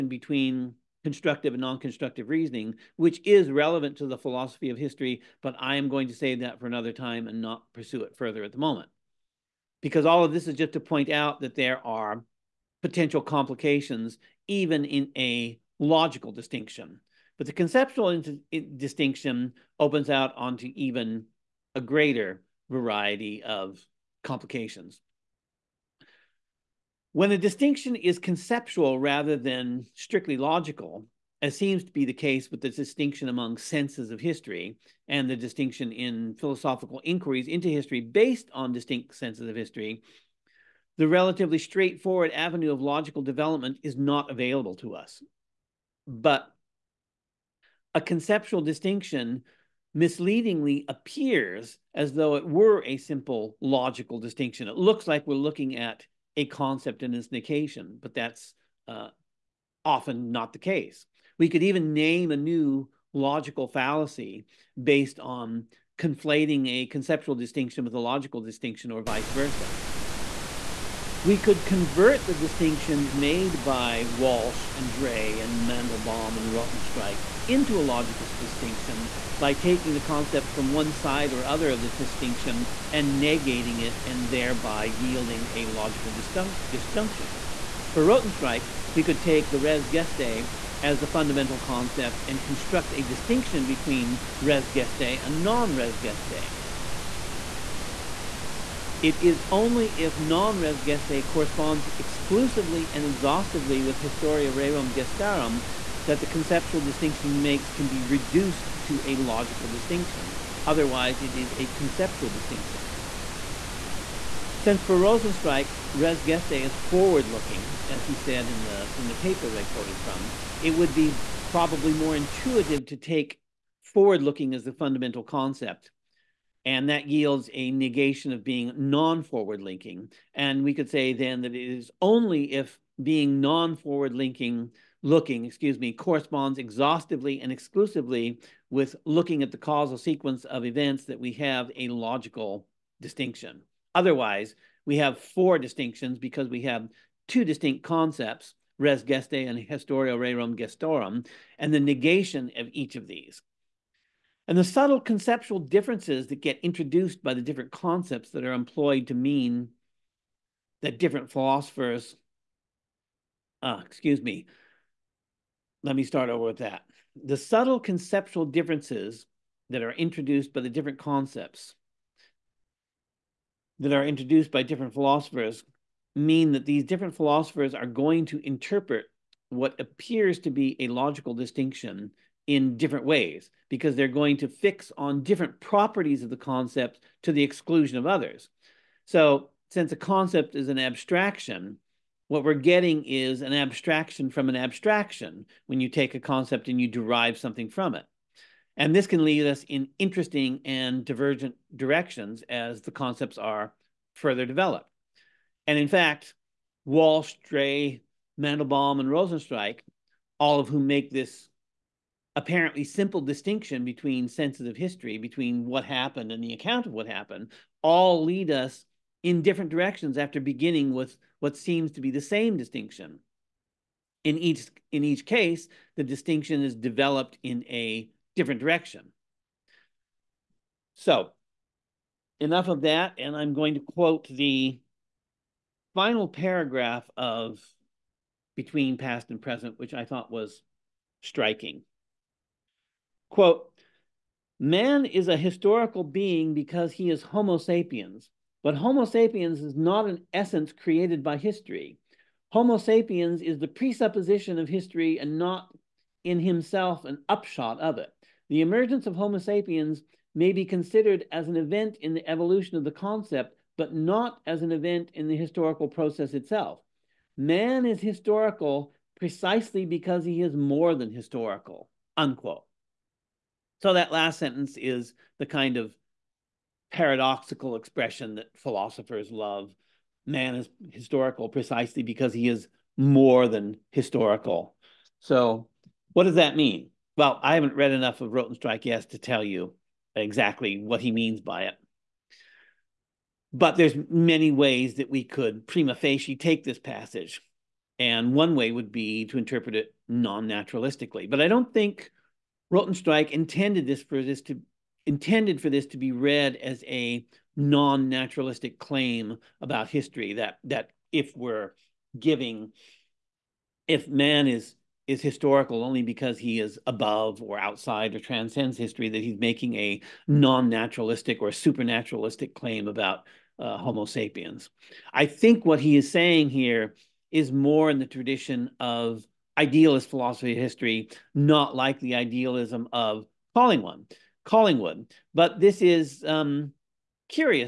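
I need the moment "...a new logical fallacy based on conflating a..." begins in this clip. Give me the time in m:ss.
1:02.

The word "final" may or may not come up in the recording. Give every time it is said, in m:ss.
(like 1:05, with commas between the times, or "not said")
3:55.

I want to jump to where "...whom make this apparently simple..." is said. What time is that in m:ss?
3:30.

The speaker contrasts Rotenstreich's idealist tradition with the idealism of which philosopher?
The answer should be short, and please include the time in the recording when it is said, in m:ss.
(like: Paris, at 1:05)
Collingwood, at 5:34.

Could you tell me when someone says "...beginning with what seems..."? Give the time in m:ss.
3:40.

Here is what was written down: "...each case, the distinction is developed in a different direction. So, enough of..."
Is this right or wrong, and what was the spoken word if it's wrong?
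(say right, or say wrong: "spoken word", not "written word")
right.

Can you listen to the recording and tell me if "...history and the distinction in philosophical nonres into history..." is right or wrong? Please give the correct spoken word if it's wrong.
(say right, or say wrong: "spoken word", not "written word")
wrong: "inquiries", not "nonres".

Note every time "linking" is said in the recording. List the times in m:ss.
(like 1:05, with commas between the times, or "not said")
2:09, 2:14.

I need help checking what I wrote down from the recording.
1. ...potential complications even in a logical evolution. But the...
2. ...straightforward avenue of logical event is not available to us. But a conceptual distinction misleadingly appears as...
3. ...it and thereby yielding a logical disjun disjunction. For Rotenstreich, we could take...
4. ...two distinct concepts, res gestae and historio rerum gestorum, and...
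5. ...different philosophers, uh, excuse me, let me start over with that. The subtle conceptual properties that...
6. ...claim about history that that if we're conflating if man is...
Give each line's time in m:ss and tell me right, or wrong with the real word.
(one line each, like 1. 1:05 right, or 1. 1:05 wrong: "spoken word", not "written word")
1. 0:12 wrong: "distinction", not "evolution"
2. 0:41 wrong: "development", not "event"
3. 1:23 right
4. 2:27 right
5. 2:40 wrong: "differences", not "properties"
6. 5:08 wrong: "giving", not "conflating".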